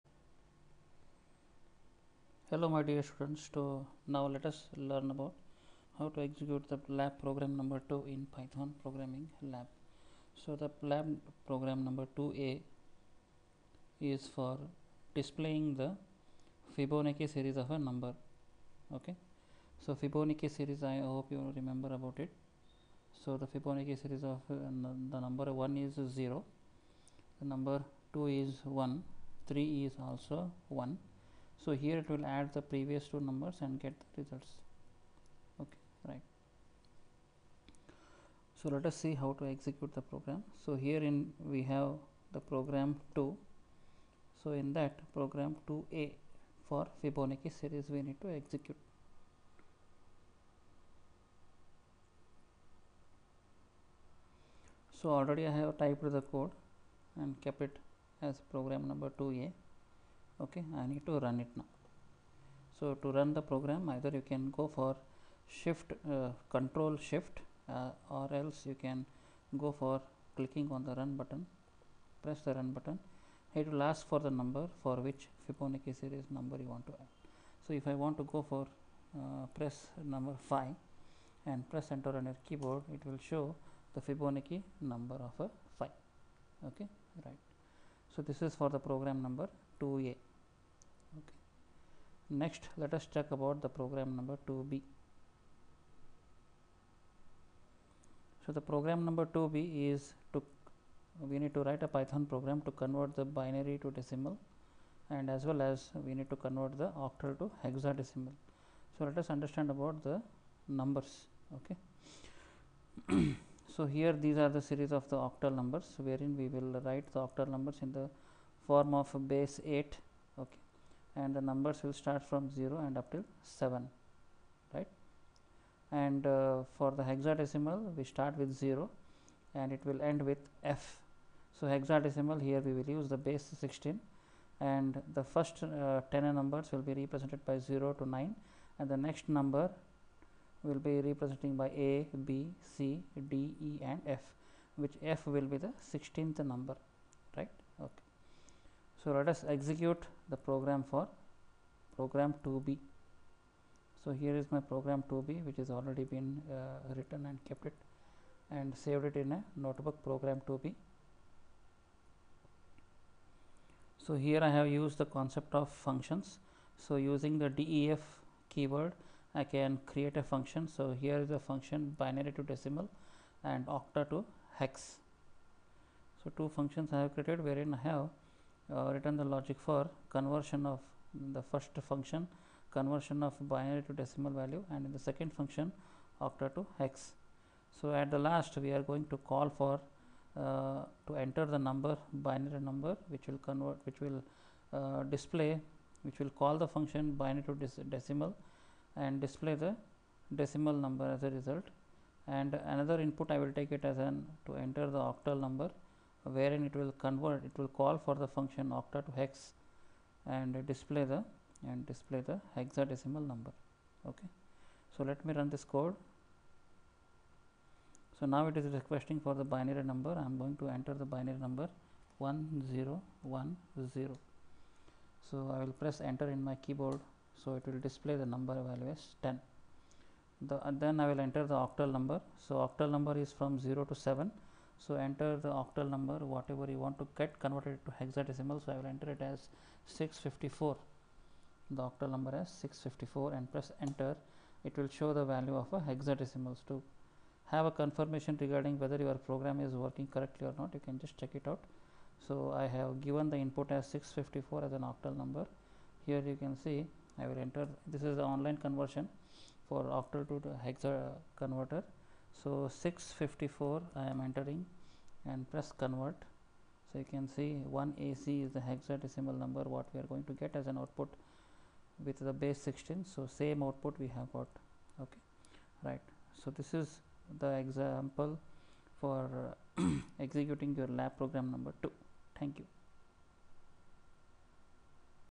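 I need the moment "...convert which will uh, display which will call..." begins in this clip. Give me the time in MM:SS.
03:13.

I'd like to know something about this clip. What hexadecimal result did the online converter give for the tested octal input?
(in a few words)
1AC.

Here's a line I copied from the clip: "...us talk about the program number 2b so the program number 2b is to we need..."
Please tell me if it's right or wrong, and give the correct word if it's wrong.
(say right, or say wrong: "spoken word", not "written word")
right.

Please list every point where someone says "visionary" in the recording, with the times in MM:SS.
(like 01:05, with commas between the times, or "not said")
not said.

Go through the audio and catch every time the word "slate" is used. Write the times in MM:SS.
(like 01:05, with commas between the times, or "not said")
not said.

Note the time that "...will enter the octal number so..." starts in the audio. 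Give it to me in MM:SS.
03:51.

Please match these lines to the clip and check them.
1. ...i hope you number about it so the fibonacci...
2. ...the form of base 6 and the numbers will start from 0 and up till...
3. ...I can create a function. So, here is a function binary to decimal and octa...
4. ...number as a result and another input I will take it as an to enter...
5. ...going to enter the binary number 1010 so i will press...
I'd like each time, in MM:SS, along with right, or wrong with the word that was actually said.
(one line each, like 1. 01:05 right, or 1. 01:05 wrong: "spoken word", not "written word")
1. 00:20 wrong: "remember", not "number"
2. 01:57 wrong: "8", not "6"
3. 02:49 right
4. 03:20 right
5. 03:40 right.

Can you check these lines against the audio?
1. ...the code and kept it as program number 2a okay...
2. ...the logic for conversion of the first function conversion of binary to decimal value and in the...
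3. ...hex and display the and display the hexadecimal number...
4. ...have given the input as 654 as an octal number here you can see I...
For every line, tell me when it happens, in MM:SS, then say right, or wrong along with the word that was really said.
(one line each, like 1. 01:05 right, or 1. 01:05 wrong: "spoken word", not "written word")
1. 00:56 right
2. 02:59 right
3. 03:29 right
4. 04:12 right.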